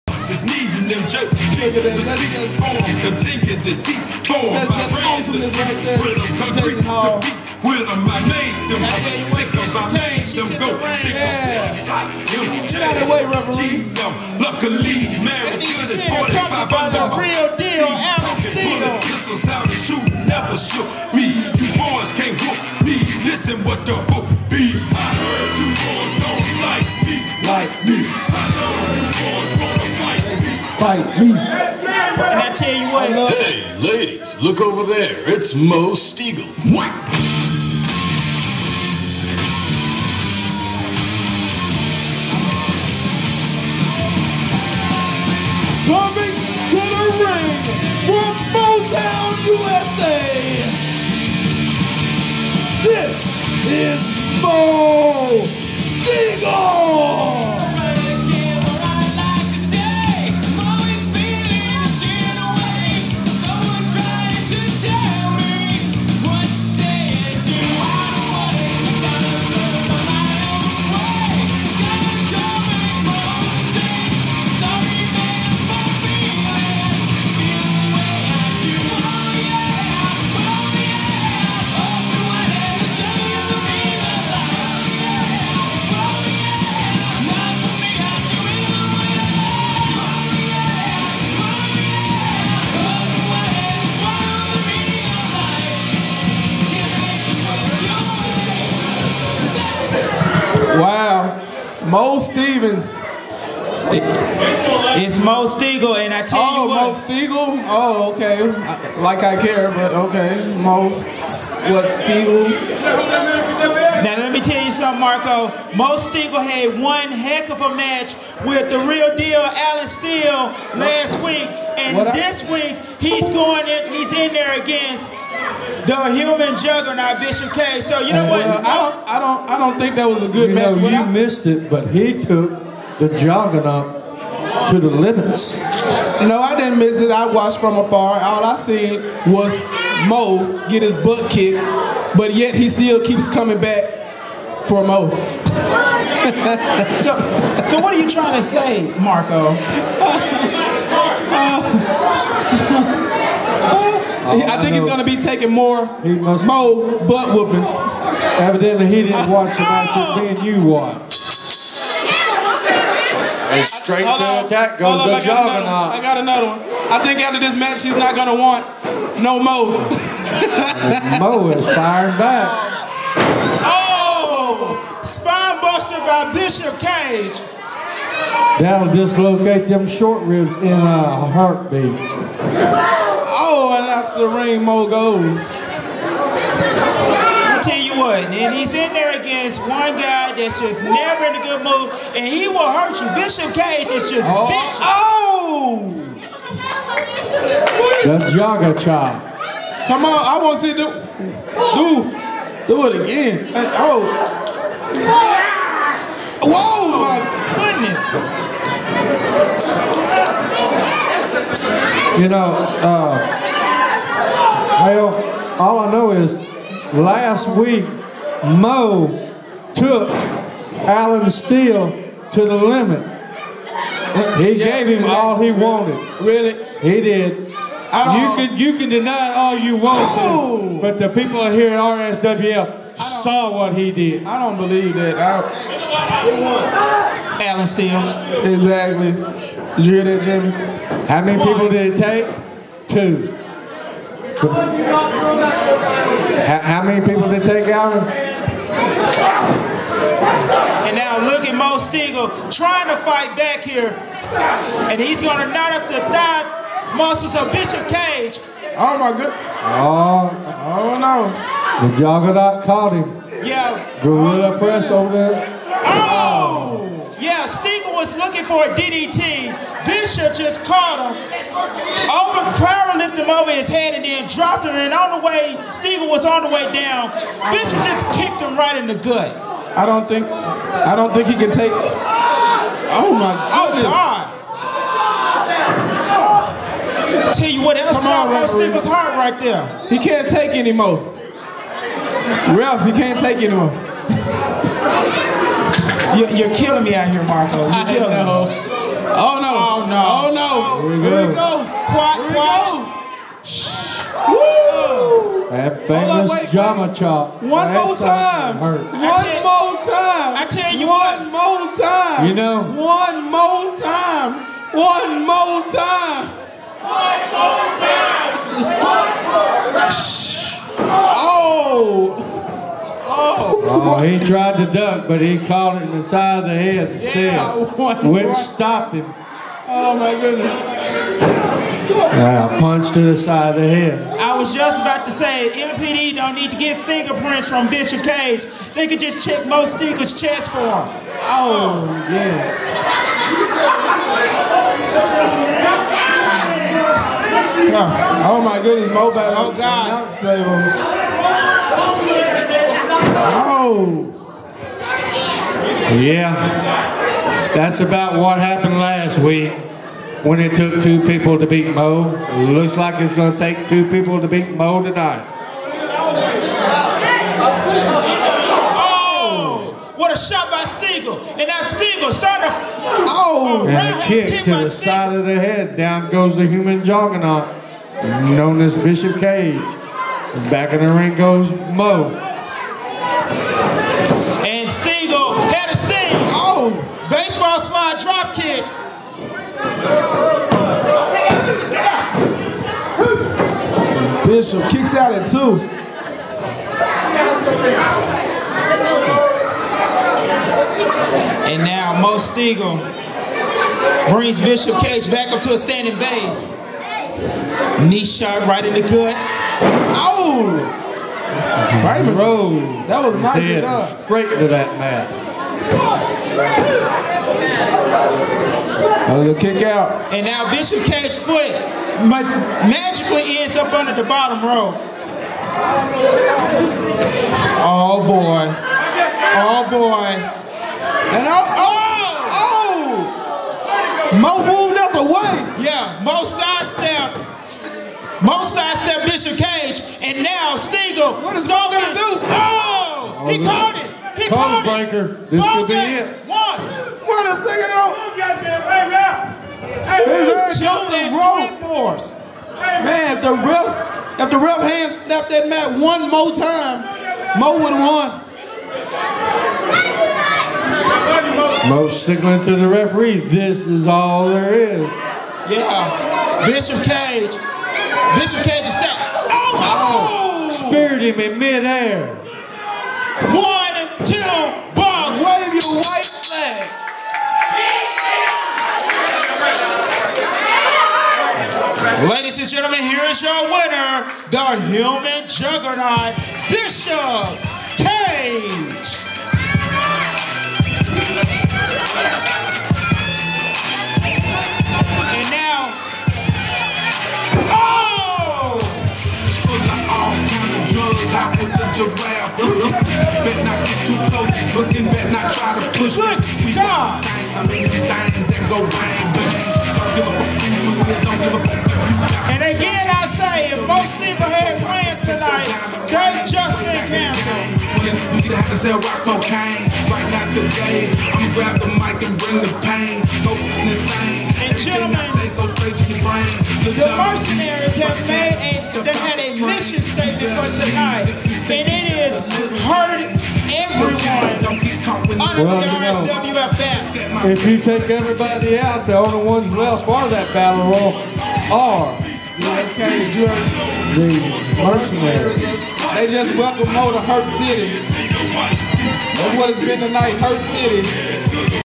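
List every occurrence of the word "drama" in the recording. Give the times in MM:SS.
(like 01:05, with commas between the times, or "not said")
05:06.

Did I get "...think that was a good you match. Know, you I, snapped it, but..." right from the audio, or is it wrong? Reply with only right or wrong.
wrong.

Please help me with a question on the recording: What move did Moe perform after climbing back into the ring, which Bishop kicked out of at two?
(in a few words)
Baseball slide drop kick.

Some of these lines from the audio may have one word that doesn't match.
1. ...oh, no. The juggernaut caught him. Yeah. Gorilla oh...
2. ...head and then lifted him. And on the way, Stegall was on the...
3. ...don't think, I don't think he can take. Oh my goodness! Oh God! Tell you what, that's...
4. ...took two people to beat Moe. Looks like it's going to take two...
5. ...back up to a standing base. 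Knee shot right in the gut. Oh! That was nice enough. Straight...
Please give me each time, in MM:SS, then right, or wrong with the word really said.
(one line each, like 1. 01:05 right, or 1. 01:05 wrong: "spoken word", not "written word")
1. 04:20 right
2. 04:33 wrong: "dropped", not "lifted"
3. 04:39 right
4. 06:00 right
5. 06:45 right.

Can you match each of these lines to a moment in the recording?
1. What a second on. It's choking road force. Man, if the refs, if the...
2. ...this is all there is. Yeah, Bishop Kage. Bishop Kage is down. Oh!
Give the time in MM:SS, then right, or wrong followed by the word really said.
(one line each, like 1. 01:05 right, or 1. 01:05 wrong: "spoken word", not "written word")
1. 07:26 right
2. 07:43 right.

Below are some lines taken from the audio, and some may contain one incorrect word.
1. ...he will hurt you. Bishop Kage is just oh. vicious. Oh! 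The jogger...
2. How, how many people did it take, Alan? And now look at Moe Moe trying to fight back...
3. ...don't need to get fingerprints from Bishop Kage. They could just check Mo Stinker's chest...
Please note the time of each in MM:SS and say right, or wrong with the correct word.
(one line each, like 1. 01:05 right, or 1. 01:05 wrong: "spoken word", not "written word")
1. 03:12 right
2. 04:06 wrong: "Stegall", not "Moe"
3. 05:36 right.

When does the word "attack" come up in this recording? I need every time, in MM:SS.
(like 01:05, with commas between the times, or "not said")
02:44.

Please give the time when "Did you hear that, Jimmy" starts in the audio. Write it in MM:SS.
03:59.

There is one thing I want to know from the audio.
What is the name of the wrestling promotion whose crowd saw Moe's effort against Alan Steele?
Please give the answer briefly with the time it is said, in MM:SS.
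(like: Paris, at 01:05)
RSWF, at 03:52.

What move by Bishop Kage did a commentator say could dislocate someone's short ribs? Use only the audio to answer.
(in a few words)
Spinebuster.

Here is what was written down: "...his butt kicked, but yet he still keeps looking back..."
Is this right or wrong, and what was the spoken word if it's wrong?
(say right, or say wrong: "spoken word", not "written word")
wrong: "coming", not "looking".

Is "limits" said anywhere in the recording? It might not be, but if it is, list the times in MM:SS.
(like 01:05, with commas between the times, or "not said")
02:14, 03:42.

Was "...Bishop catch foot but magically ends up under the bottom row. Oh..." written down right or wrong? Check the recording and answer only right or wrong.
right.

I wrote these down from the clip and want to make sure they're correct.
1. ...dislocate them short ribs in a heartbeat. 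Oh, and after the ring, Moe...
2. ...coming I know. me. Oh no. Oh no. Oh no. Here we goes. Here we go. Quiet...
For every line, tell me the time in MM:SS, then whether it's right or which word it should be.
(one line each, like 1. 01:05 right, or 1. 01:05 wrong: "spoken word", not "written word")
1. 02:58 right
2. 04:57 wrong: "killing", not "coming".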